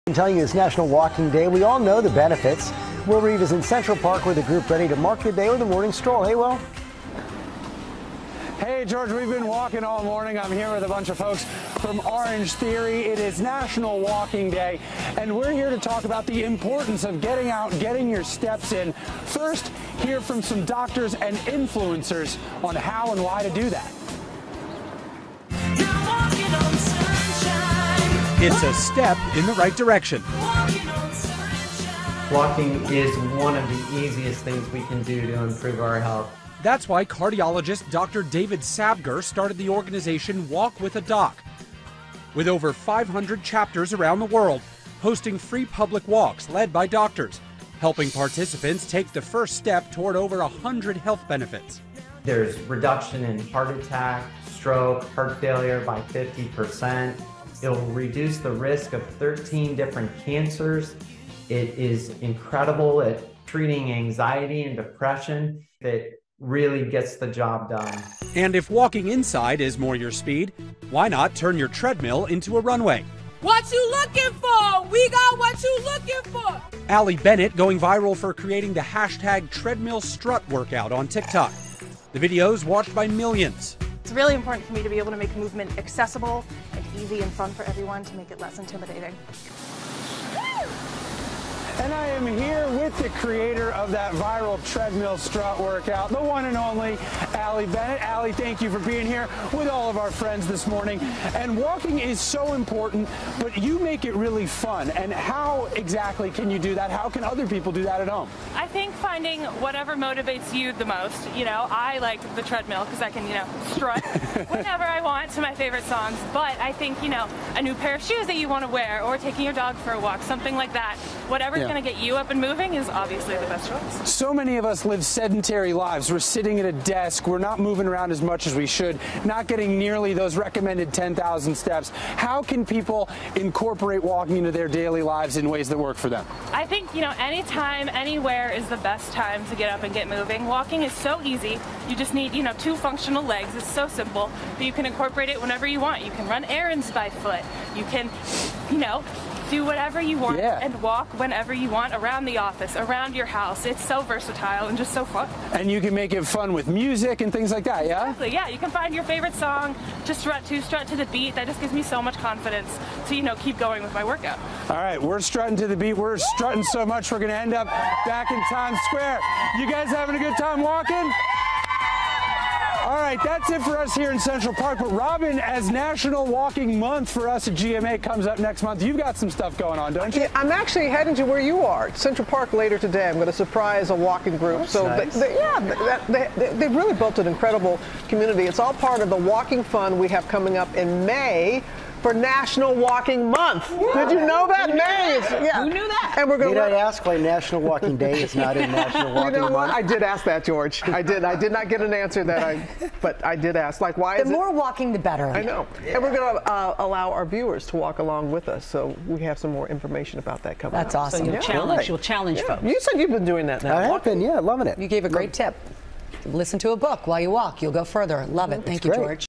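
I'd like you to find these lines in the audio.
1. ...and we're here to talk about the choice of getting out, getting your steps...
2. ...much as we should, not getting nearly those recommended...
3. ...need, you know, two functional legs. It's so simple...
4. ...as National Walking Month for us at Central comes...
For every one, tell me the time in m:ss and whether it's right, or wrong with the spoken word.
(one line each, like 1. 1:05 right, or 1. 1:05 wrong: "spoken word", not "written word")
1. 0:15 wrong: "importance", not "choice"
2. 2:08 right
3. 2:22 right
4. 2:55 wrong: "GMA", not "Central".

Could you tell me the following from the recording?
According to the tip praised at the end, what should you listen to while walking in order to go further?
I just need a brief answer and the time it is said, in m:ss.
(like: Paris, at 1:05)
A book, at 3:36.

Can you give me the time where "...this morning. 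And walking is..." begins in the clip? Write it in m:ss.
1:40.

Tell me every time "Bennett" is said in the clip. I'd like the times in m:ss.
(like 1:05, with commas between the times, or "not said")
1:17, 1:37.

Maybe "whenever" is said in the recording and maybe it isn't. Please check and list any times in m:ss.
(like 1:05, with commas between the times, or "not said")
1:54, 2:25, 2:31.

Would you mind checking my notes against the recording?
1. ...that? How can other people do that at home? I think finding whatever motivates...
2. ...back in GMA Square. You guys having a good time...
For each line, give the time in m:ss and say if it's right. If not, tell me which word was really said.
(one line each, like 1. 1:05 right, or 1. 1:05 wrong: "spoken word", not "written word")
1. 1:46 right
2. 2:48 wrong: "Times", not "GMA".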